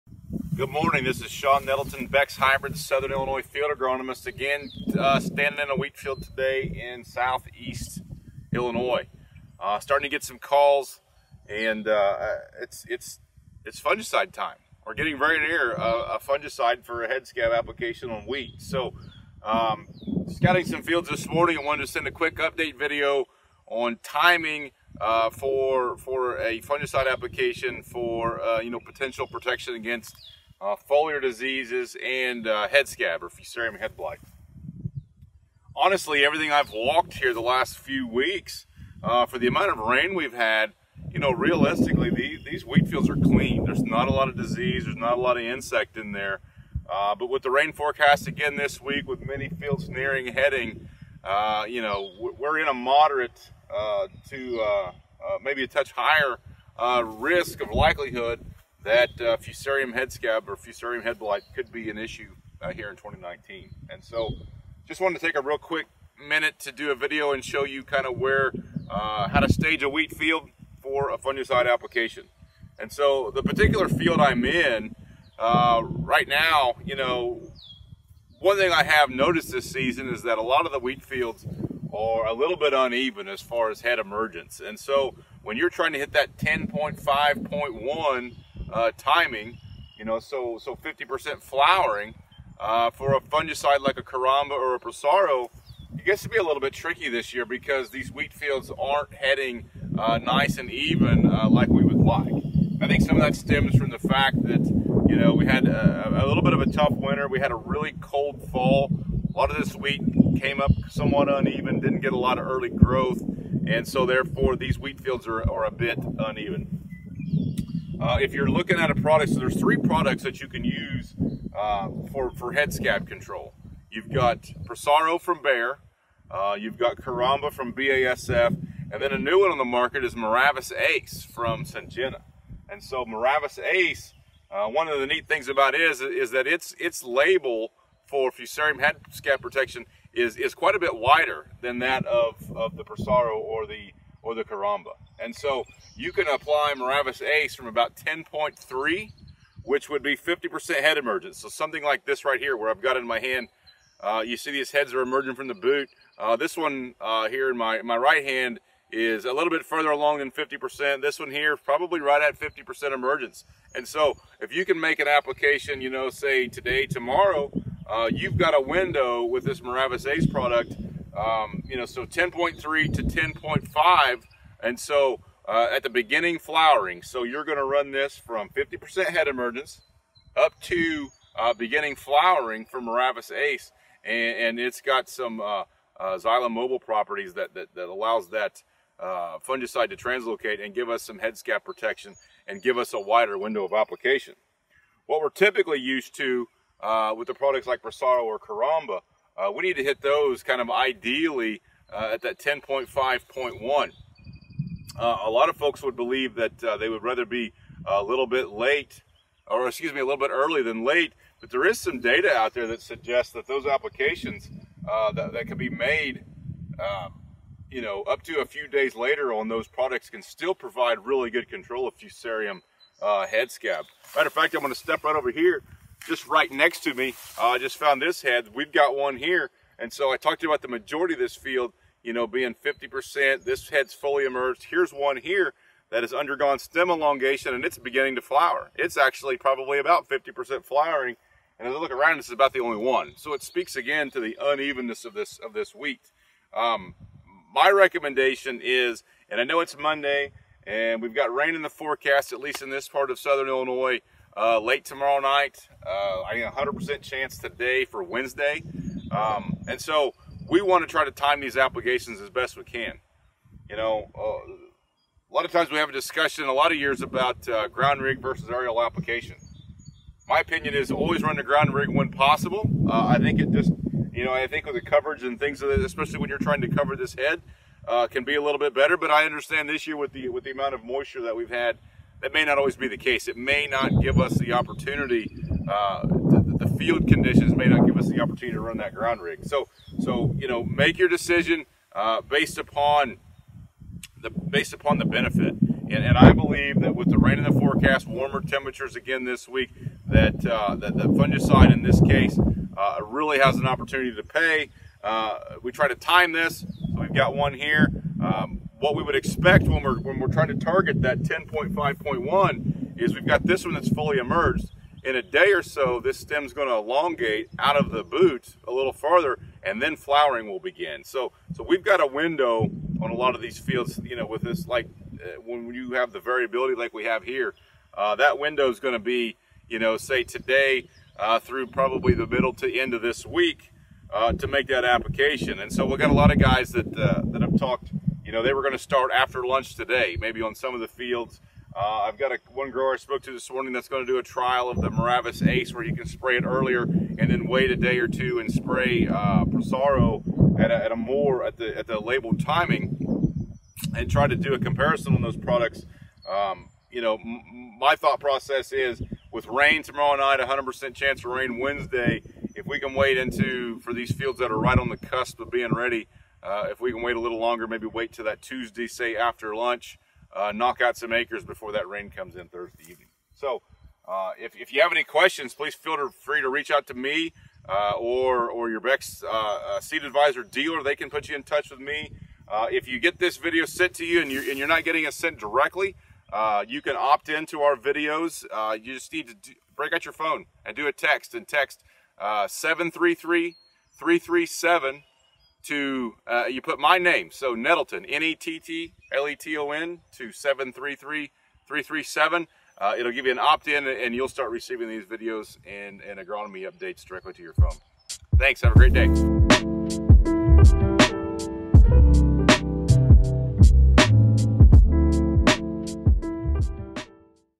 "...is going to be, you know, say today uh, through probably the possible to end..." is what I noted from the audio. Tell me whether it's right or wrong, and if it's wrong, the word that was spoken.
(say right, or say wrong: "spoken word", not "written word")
wrong: "middle", not "possible".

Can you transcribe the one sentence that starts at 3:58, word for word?
It's actually probably about 50% flowering.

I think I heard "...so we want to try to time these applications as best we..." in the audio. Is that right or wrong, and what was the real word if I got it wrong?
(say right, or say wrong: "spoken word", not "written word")
right.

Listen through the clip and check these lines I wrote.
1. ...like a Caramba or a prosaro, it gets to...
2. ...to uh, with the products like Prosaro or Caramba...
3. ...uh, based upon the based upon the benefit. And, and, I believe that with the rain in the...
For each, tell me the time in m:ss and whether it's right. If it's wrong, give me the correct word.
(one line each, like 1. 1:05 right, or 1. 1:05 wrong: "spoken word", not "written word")
1. 1:33 right
2. 3:16 right
3. 4:51 right.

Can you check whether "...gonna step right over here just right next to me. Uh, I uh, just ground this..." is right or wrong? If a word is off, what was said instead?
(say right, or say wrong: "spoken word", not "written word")
wrong: "found", not "ground".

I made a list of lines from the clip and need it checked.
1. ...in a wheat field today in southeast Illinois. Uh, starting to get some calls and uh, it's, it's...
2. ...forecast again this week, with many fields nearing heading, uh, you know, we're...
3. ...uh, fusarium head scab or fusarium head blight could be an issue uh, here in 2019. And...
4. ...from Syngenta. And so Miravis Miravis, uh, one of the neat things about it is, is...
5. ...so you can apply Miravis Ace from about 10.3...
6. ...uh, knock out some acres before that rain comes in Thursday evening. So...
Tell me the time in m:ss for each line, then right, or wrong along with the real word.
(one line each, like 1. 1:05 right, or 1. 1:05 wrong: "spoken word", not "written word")
1. 0:05 right
2. 0:47 right
3. 0:59 right
4. 2:11 wrong: "Ace", not "Miravis"
5. 2:25 right
6. 6:10 right.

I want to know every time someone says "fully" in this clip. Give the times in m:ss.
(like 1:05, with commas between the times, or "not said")
3:53, 5:13.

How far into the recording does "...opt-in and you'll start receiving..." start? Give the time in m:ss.
6:43.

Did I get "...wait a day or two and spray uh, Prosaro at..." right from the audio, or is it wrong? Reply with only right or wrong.
right.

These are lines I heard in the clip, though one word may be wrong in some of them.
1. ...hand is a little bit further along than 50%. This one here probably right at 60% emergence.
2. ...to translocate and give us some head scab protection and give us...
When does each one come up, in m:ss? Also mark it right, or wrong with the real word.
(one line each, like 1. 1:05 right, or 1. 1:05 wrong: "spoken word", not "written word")
1. 2:38 wrong: "50", not "60"
2. 3:09 right.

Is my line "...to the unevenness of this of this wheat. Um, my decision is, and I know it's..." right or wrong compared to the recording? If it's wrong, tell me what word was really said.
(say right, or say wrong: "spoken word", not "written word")
wrong: "recommendation", not "decision".